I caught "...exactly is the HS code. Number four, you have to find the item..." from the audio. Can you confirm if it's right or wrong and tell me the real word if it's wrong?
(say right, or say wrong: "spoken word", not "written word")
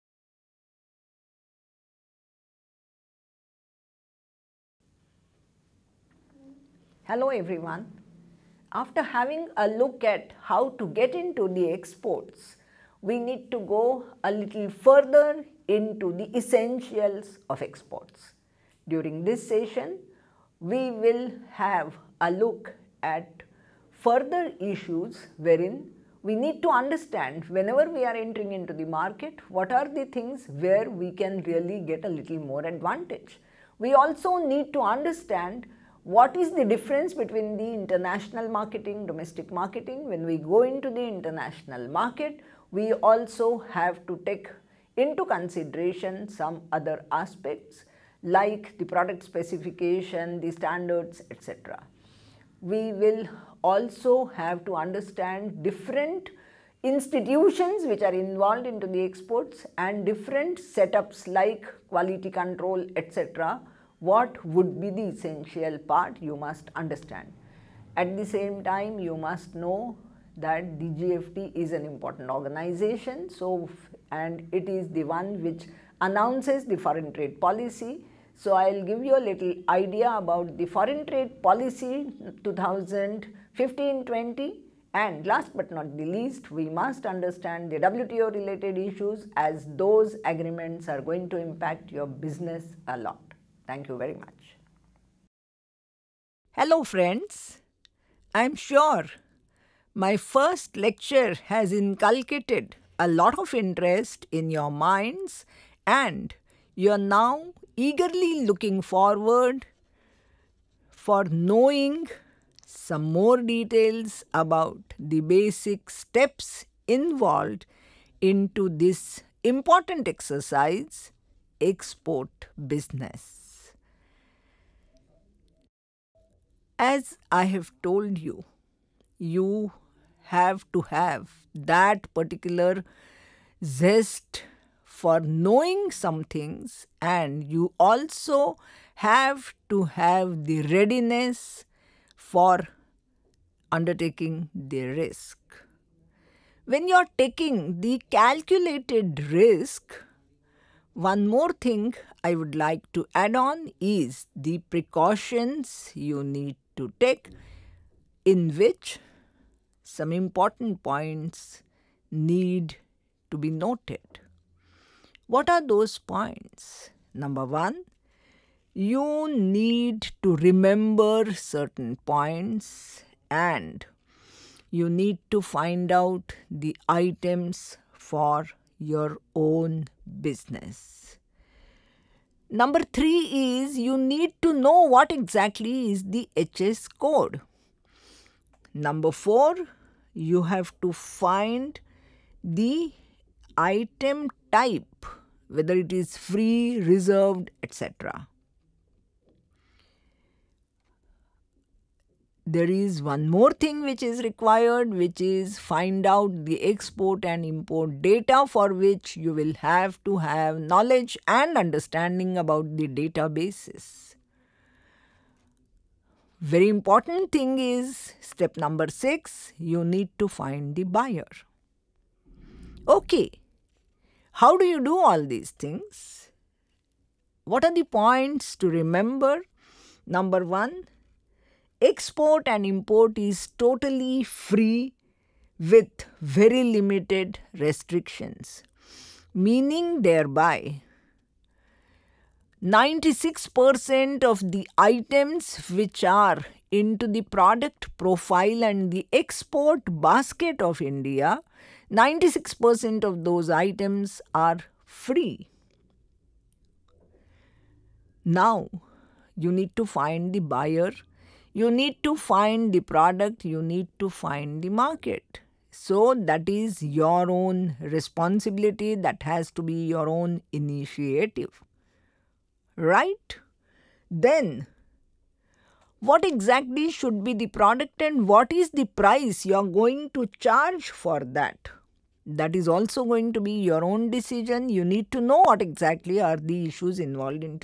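right.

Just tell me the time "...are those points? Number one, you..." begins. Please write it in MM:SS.
02:45.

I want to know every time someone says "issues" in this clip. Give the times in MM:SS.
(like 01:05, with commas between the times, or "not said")
00:24, 01:28, 04:46.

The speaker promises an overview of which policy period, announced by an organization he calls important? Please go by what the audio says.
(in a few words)
2015-20.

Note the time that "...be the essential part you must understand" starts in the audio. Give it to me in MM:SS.
01:04.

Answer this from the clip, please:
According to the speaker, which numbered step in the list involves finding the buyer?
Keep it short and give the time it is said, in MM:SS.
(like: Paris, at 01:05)
6, at 03:38.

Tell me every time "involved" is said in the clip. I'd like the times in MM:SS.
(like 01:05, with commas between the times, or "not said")
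00:58, 01:56, 04:46.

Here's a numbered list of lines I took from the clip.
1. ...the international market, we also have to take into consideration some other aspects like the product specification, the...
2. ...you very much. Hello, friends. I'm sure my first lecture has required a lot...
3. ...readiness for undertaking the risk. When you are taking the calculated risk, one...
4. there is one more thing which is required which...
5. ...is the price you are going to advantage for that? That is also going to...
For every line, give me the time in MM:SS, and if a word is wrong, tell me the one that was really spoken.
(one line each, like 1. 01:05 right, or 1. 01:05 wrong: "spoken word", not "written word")
1. 00:40 right
2. 01:33 wrong: "inculcated", not "required"
3. 02:20 right
4. 03:22 right
5. 04:38 wrong: "charge", not "advantage".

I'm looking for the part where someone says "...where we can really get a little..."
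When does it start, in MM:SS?
00:30.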